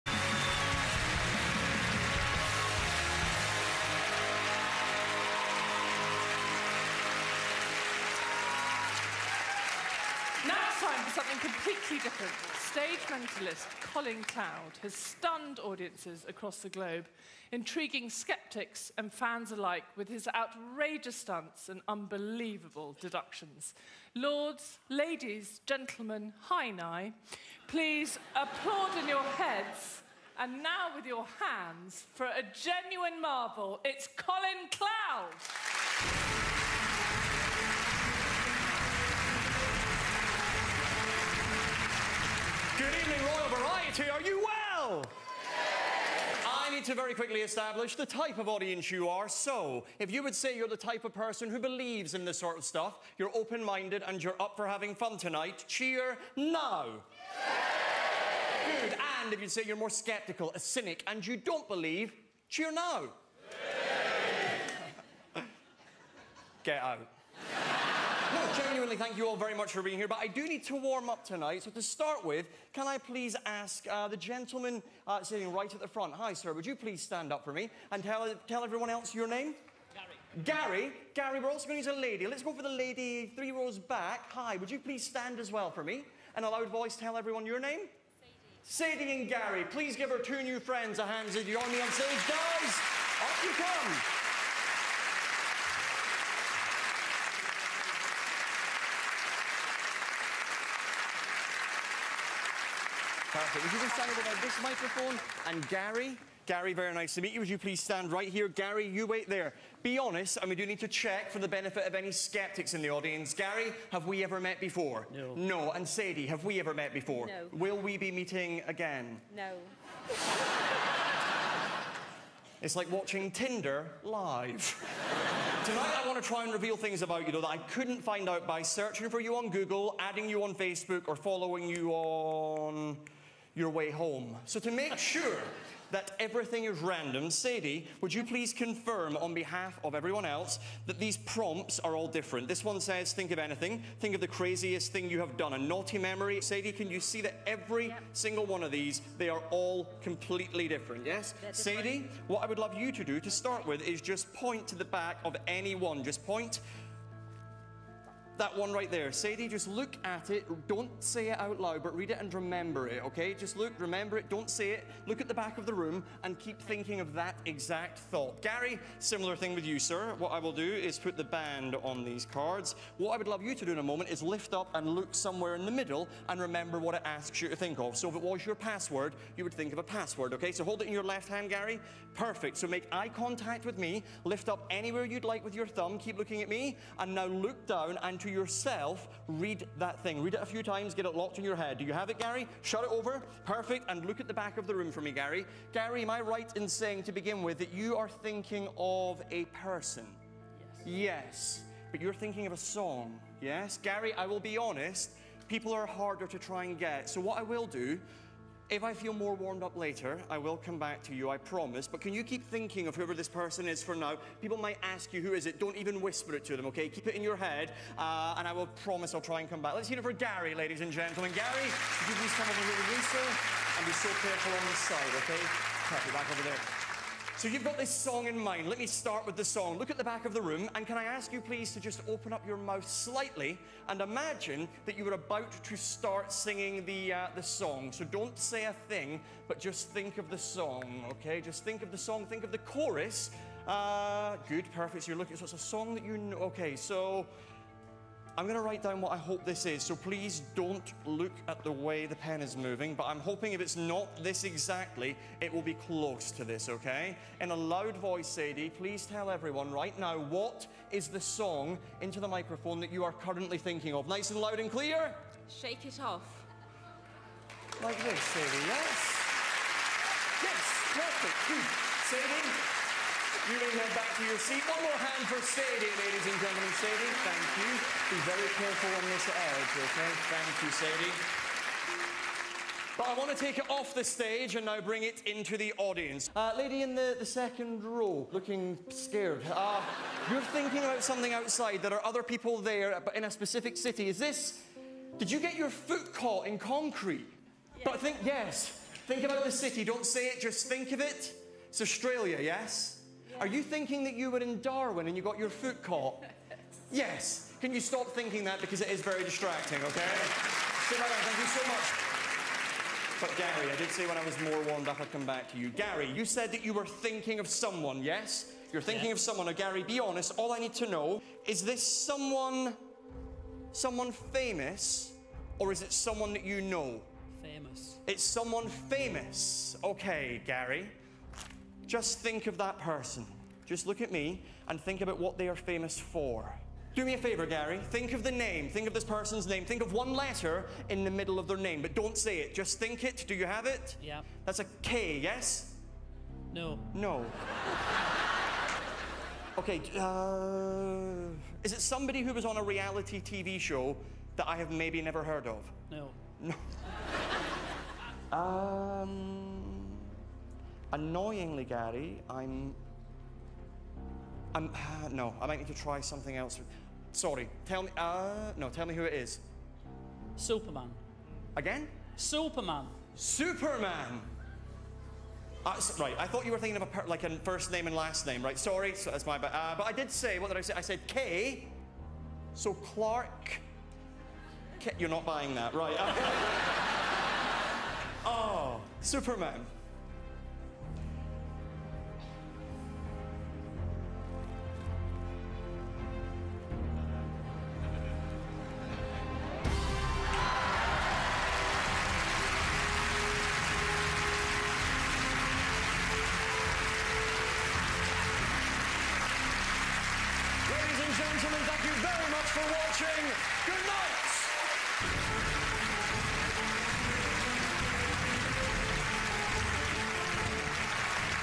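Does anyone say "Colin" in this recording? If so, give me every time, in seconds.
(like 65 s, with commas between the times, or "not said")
13 s, 34 s.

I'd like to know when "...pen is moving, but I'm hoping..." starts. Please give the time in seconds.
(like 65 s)
252 s.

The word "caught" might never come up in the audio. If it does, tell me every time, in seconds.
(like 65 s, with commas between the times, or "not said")
296 s, 305 s.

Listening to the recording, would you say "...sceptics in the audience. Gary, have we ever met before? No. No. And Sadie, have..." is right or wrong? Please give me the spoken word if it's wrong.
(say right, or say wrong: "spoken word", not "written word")
right.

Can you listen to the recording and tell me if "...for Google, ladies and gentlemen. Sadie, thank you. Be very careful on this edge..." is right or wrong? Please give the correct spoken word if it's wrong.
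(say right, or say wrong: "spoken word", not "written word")
wrong: "Sadie", not "Google".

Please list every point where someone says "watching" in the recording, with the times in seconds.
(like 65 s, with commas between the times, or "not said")
122 s, 412 s.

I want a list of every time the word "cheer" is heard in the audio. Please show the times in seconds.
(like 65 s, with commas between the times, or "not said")
55 s, 62 s.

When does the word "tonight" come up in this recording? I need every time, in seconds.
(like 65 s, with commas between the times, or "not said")
55 s, 71 s, 125 s.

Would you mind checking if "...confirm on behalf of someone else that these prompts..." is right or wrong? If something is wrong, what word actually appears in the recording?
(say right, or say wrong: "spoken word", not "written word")
wrong: "everyone", not "someone".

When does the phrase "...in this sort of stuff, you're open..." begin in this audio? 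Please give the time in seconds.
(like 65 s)
52 s.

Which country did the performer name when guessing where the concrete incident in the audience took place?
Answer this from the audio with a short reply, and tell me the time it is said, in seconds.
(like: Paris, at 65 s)
Australia, at 301 s.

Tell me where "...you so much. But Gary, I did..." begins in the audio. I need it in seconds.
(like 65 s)
311 s.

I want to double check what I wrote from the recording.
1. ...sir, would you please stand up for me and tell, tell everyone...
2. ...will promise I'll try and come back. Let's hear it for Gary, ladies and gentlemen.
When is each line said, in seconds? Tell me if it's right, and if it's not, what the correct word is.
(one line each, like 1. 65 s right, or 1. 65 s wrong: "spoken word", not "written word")
1. 76 s right
2. 218 s right.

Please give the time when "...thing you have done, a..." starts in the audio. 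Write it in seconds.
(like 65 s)
144 s.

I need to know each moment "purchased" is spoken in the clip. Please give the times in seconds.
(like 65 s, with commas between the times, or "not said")
not said.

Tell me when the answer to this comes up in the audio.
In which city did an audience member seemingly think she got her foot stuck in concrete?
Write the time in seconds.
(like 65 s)
304 s.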